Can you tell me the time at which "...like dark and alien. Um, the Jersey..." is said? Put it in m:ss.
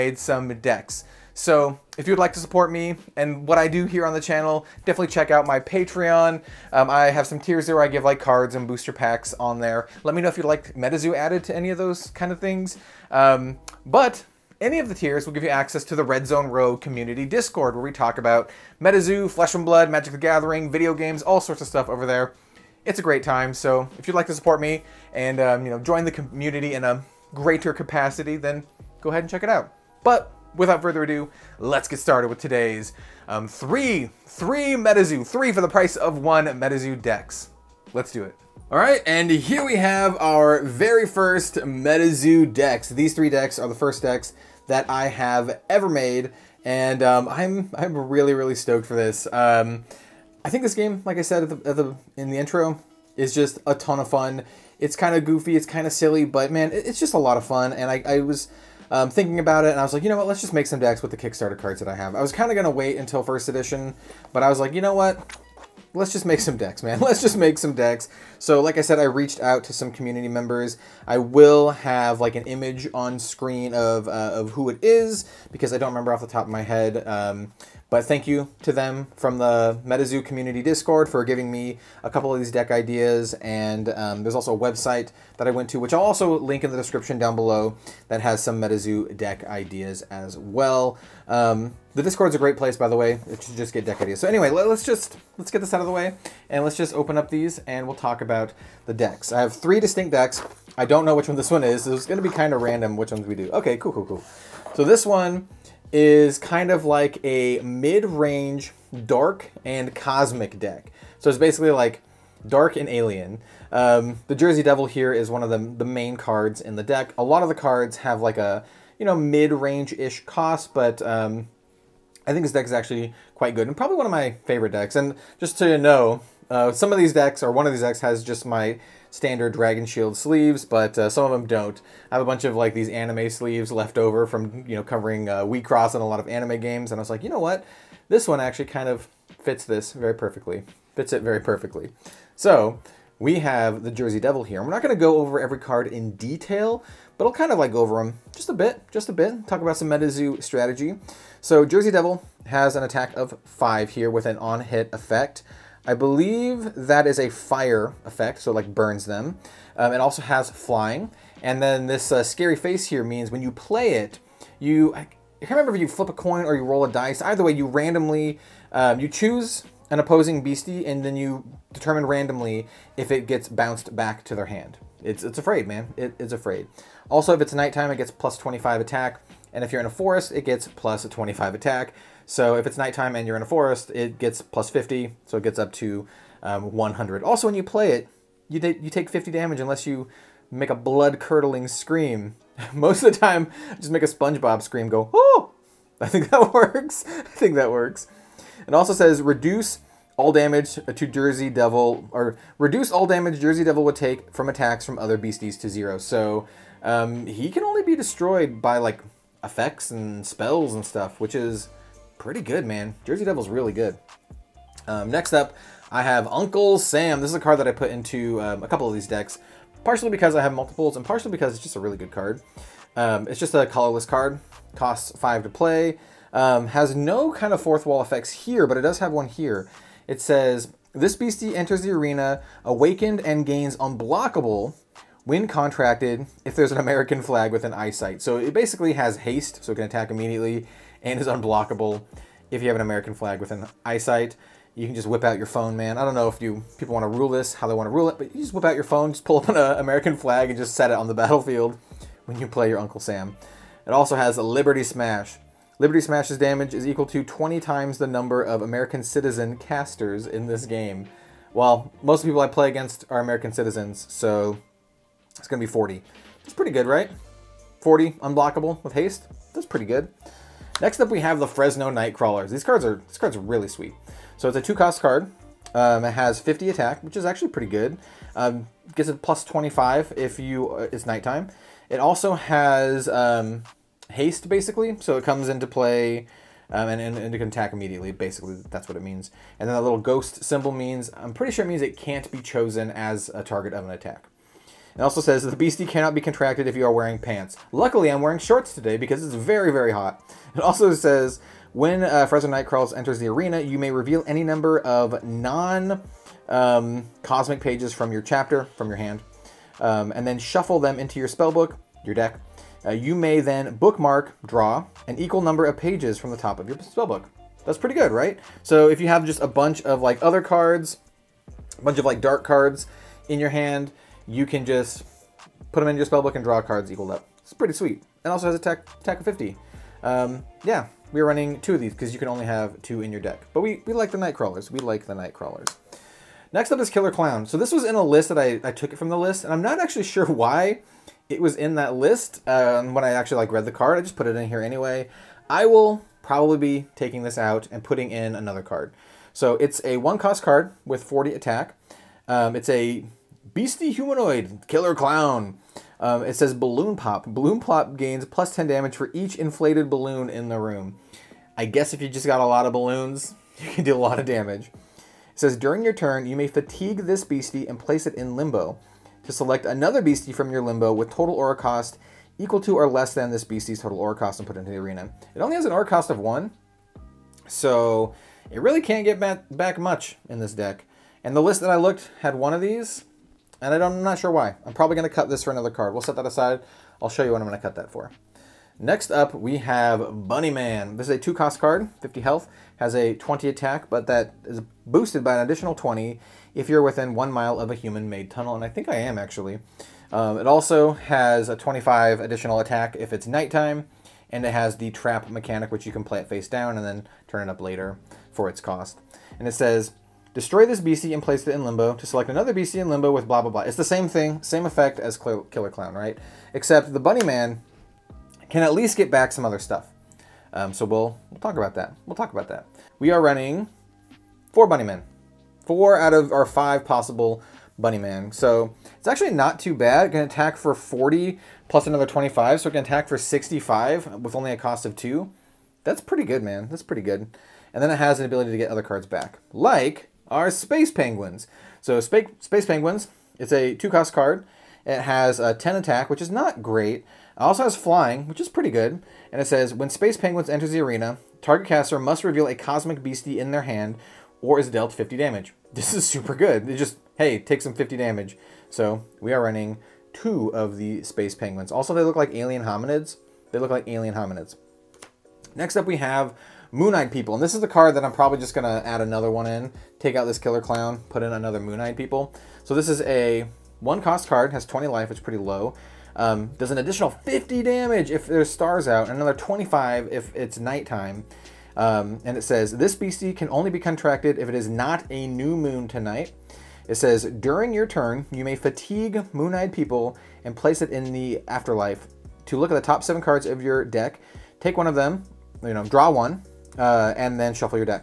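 1:51.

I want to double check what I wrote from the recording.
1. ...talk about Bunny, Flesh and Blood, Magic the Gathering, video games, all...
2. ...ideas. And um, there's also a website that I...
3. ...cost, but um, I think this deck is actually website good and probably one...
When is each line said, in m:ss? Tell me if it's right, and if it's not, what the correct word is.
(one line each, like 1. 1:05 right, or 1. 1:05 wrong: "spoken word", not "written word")
1. 0:17 wrong: "MetaZoo", not "Bunny"
2. 1:22 right
3. 2:00 wrong: "quite", not "website".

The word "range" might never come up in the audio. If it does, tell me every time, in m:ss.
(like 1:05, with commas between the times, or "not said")
1:47, 1:59.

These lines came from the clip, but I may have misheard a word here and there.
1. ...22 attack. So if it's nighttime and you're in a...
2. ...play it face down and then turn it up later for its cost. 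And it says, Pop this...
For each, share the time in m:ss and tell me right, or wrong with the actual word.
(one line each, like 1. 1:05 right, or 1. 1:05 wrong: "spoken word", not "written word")
1. 3:01 wrong: "25", not "22"
2. 6:46 wrong: "Destroy", not "Pop".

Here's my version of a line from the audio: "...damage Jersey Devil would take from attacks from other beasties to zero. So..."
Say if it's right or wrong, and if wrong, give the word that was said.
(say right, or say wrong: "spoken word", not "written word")
right.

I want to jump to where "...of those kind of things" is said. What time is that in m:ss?
0:11.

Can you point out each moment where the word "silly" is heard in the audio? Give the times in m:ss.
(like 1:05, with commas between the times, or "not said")
0:55.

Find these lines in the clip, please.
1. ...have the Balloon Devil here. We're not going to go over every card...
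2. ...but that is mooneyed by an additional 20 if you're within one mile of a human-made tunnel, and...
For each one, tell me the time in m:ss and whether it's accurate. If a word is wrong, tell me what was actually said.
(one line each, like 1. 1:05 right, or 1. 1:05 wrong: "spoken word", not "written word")
1. 2:23 wrong: "Jersey", not "Balloon"
2. 6:33 wrong: "boosted", not "mooneyed".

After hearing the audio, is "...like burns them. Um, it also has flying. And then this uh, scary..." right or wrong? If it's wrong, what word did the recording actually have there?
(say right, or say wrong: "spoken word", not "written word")
right.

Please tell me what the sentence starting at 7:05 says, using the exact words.
Four out of our five possible Bunny Man.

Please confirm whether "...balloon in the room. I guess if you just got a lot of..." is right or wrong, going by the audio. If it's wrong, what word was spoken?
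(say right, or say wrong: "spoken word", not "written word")
right.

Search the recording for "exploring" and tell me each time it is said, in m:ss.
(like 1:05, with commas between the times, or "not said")
not said.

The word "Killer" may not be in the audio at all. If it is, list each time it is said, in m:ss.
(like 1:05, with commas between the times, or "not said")
5:36, 5:54, 6:55, 7:50.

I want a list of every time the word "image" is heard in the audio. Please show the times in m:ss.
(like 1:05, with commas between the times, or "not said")
1:12.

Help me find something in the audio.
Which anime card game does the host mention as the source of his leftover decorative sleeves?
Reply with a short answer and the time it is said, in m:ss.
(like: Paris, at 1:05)
Wixoss, at 2:15.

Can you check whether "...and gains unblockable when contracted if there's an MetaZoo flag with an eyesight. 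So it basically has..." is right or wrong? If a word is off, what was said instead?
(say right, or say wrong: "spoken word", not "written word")
wrong: "American", not "MetaZoo".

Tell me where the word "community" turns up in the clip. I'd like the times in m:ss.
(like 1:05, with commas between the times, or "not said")
0:16, 0:26, 1:09, 1:20.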